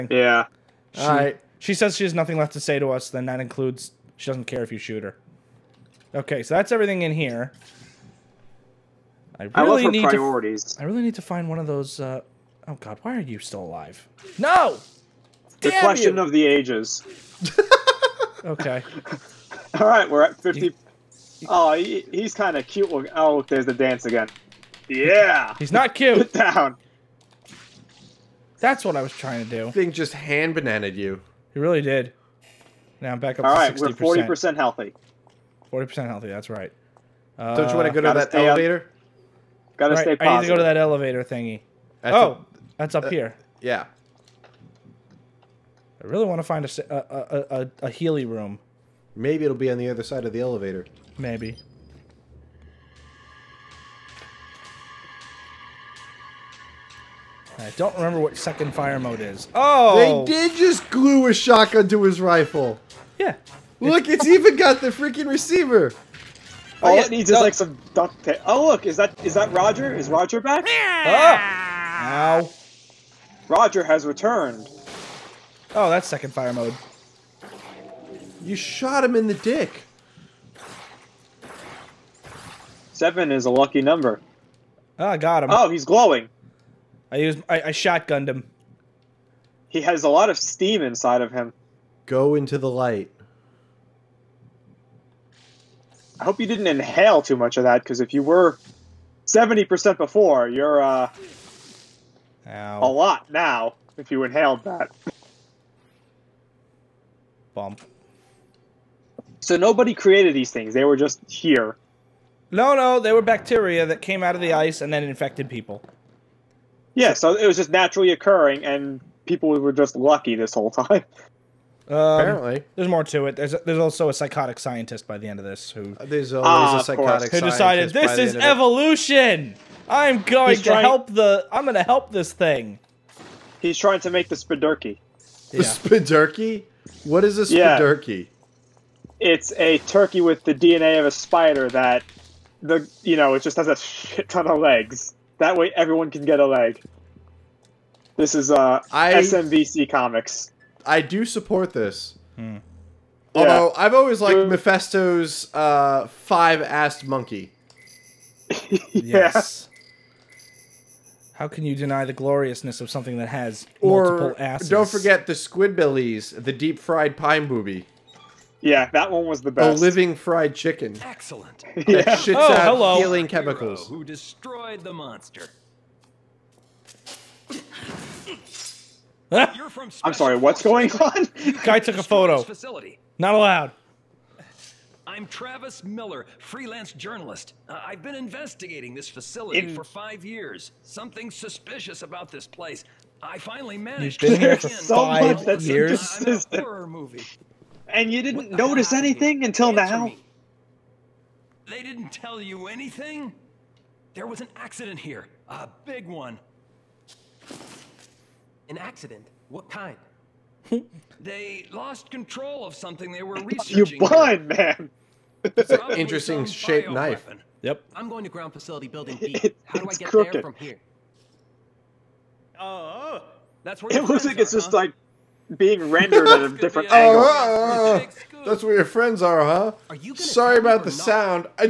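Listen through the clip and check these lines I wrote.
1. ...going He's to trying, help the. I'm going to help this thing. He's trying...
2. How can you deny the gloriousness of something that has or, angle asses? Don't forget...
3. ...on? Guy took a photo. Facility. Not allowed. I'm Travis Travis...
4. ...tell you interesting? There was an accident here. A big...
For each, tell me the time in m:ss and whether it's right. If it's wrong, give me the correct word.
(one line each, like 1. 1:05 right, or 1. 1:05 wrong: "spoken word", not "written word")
1. 2:10 right
2. 2:41 wrong: "multiple", not "angle"
3. 3:00 wrong: "Miller", not "Travis"
4. 3:22 wrong: "anything", not "interesting".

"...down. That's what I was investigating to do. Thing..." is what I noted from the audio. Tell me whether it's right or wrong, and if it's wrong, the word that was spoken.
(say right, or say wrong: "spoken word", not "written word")
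wrong: "trying", not "investigating".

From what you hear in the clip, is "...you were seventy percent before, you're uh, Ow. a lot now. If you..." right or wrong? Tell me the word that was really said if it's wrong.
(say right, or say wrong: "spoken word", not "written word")
right.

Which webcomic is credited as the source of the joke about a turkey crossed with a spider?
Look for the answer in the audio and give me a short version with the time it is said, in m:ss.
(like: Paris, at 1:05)
SMBC Comics, at 2:29.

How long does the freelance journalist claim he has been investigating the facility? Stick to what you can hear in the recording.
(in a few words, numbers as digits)
5 years.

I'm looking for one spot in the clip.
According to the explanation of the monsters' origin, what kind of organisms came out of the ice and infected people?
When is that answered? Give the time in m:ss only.
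1:53.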